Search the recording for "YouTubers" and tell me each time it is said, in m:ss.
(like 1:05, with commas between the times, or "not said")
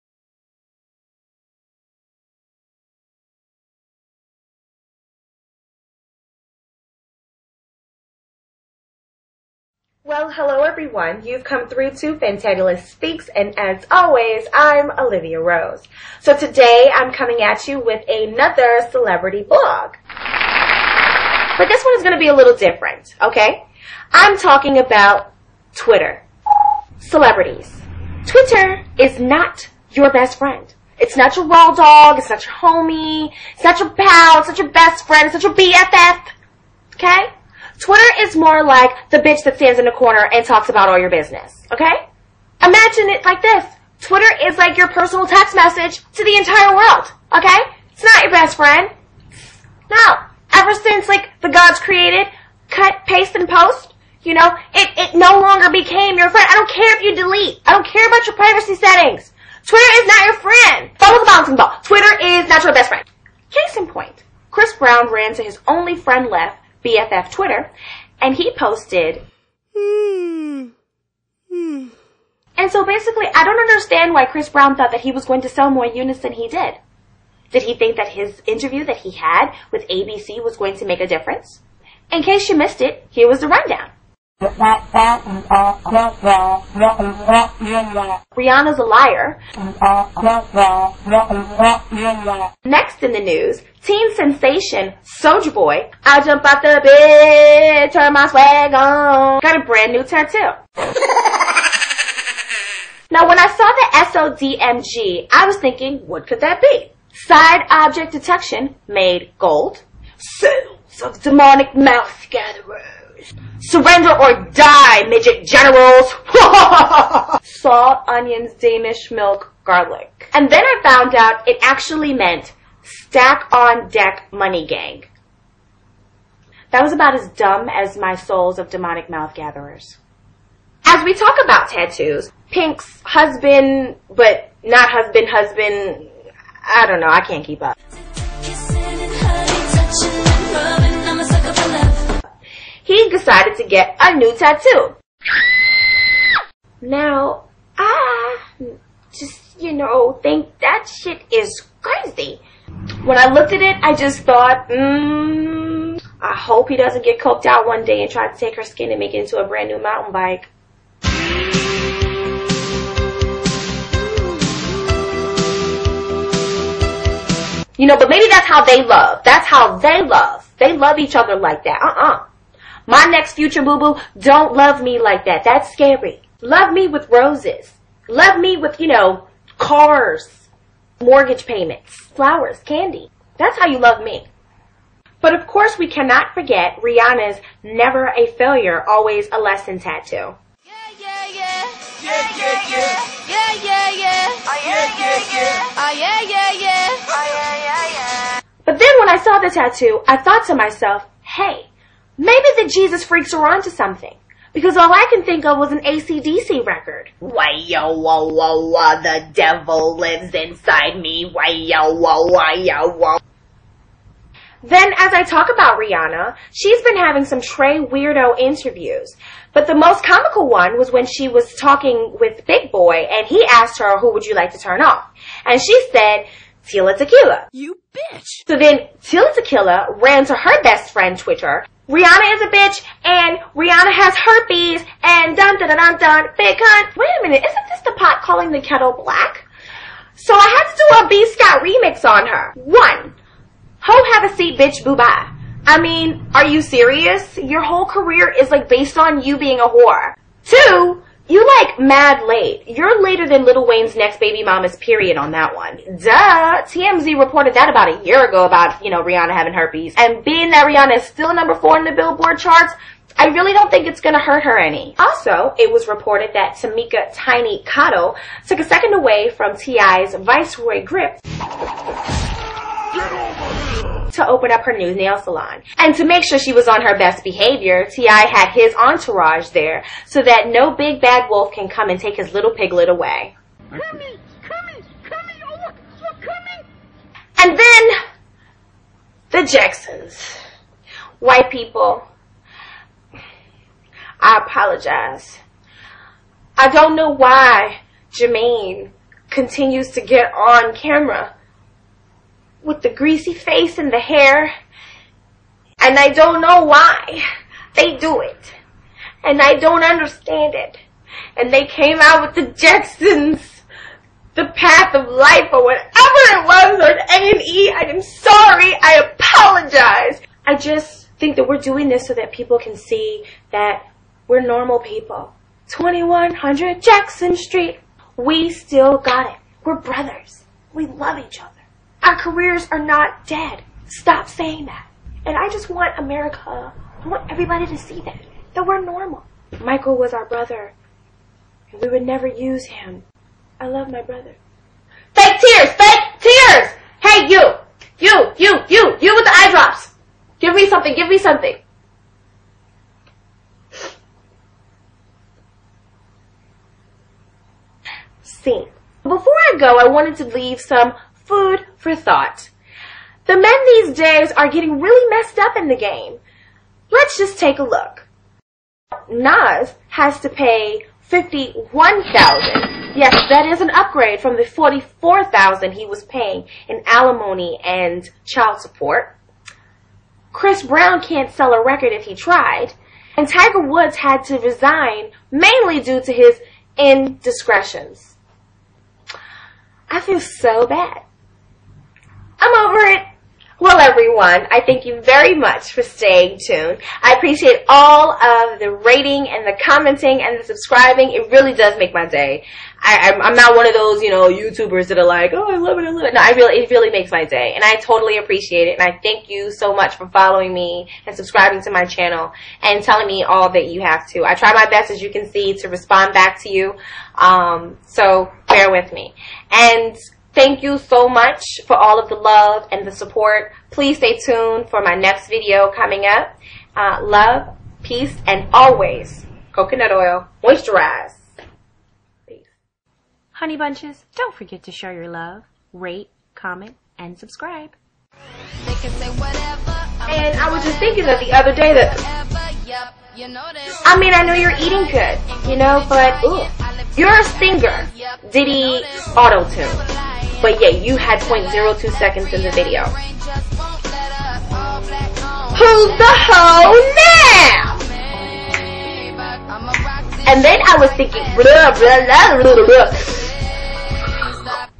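6:44.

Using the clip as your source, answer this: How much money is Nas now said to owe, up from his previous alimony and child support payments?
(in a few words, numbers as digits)
51,000.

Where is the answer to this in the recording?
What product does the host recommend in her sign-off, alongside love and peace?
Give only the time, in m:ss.
7:09.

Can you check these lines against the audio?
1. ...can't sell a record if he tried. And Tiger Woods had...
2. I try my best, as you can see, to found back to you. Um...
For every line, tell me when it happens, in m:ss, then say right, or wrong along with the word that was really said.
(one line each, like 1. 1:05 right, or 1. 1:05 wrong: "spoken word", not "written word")
1. 6:21 right
2. 6:54 wrong: "respond", not "found".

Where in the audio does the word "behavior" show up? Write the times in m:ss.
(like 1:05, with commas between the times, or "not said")
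4:37.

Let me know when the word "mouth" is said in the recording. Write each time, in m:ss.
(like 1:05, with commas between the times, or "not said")
1:51, 2:09.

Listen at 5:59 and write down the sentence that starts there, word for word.
Before I go, I wanted to leave some Food for thought.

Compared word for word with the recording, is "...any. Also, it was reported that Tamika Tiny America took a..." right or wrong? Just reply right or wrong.
wrong.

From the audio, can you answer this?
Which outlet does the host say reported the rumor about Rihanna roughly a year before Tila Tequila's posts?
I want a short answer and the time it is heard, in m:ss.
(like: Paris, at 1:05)
TMZ, at 4:16.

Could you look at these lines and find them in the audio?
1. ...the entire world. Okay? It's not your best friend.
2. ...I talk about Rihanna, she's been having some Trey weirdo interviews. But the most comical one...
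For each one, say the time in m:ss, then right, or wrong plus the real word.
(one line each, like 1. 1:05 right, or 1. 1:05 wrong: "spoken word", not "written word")
1. 0:46 right
2. 3:35 right.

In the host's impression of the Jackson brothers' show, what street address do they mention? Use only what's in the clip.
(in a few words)
2100 Jackson Street.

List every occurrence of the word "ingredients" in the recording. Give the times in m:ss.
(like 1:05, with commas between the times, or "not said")
not said.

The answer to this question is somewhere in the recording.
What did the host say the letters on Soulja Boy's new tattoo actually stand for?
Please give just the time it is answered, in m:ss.
2:02.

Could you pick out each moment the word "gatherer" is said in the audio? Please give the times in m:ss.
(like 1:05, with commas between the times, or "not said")
1:52, 2:09.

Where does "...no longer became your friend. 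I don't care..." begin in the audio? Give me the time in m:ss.
0:55.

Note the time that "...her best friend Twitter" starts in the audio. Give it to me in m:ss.
3:50.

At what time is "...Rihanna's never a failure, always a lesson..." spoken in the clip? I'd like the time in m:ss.
3:06.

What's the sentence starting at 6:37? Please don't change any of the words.
I appreciate all of the rating and the commenting and the subscribing.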